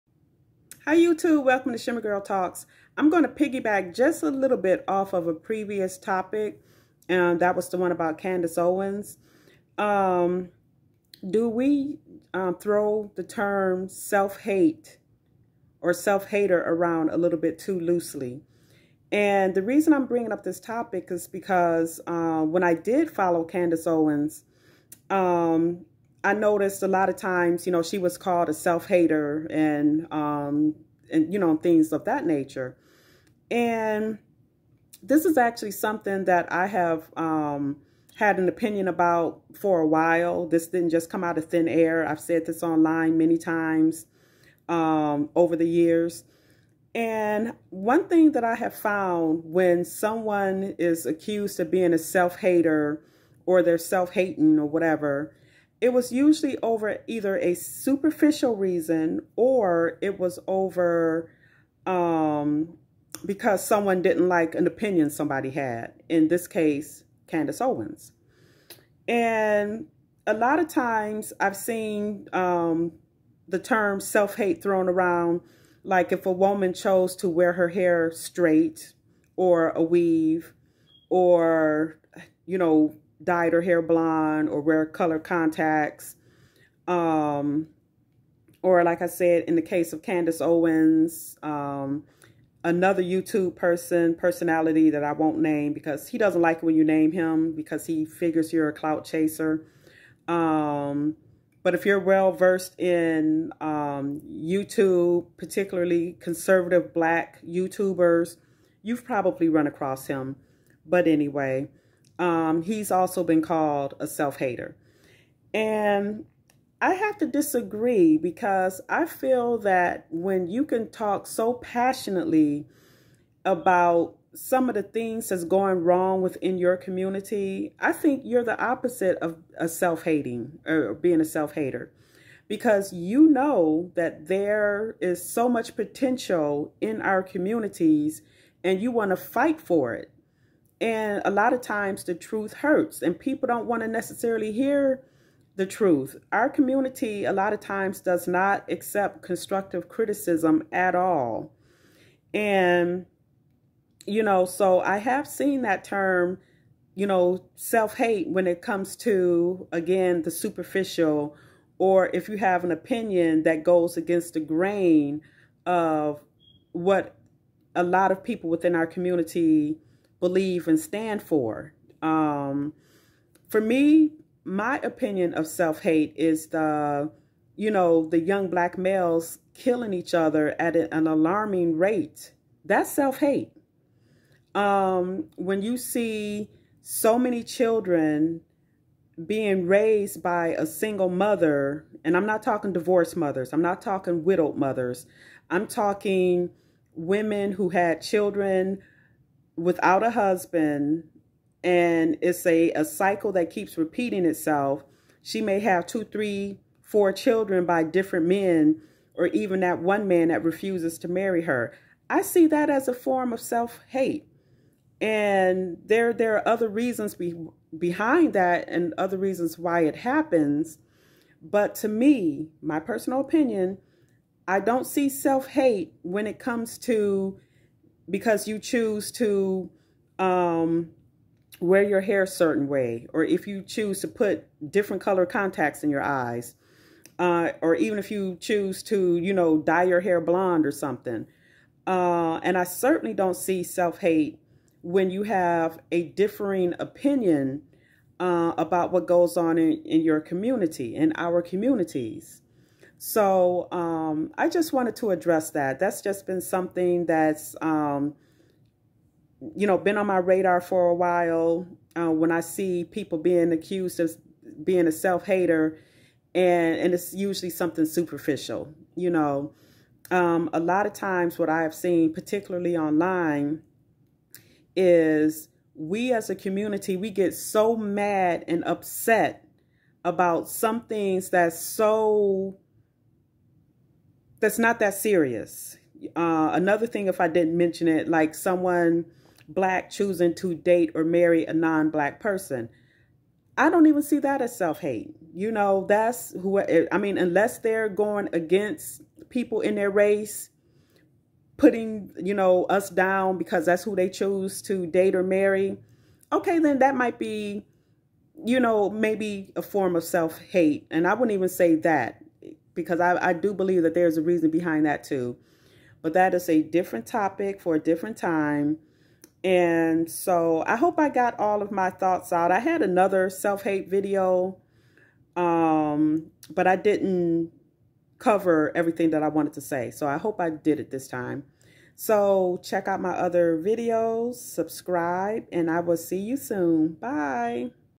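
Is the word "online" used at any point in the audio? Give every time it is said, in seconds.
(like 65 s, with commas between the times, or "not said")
42 s, 272 s.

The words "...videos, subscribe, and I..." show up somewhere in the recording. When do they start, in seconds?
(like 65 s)
333 s.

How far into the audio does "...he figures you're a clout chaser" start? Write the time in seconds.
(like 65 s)
97 s.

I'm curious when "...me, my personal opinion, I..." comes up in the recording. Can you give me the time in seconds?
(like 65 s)
221 s.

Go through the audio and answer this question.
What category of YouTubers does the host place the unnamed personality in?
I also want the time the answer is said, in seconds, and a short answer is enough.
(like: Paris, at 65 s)
Conservative black YouTubers, at 106 s.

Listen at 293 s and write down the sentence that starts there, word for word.
I don't even see that as self-hate.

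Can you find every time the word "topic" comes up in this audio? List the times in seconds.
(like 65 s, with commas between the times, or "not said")
5 s, 20 s, 317 s.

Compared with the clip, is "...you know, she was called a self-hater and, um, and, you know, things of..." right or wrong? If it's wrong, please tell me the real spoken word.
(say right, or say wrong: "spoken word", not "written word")
right.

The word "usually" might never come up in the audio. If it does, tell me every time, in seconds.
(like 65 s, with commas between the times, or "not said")
56 s, 267 s.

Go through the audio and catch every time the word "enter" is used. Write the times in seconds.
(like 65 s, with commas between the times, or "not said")
not said.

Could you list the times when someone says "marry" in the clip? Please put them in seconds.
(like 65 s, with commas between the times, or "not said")
211 s, 291 s, 305 s.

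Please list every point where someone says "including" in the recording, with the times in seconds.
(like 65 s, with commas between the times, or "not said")
not said.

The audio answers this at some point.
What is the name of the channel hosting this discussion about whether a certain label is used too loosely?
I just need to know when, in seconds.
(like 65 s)
1 s.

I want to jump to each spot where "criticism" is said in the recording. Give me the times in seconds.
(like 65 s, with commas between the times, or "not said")
149 s.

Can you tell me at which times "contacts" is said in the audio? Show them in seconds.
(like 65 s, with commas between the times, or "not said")
85 s, 235 s.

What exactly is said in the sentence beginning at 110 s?
But anyway, um, he's also been called a self-hater.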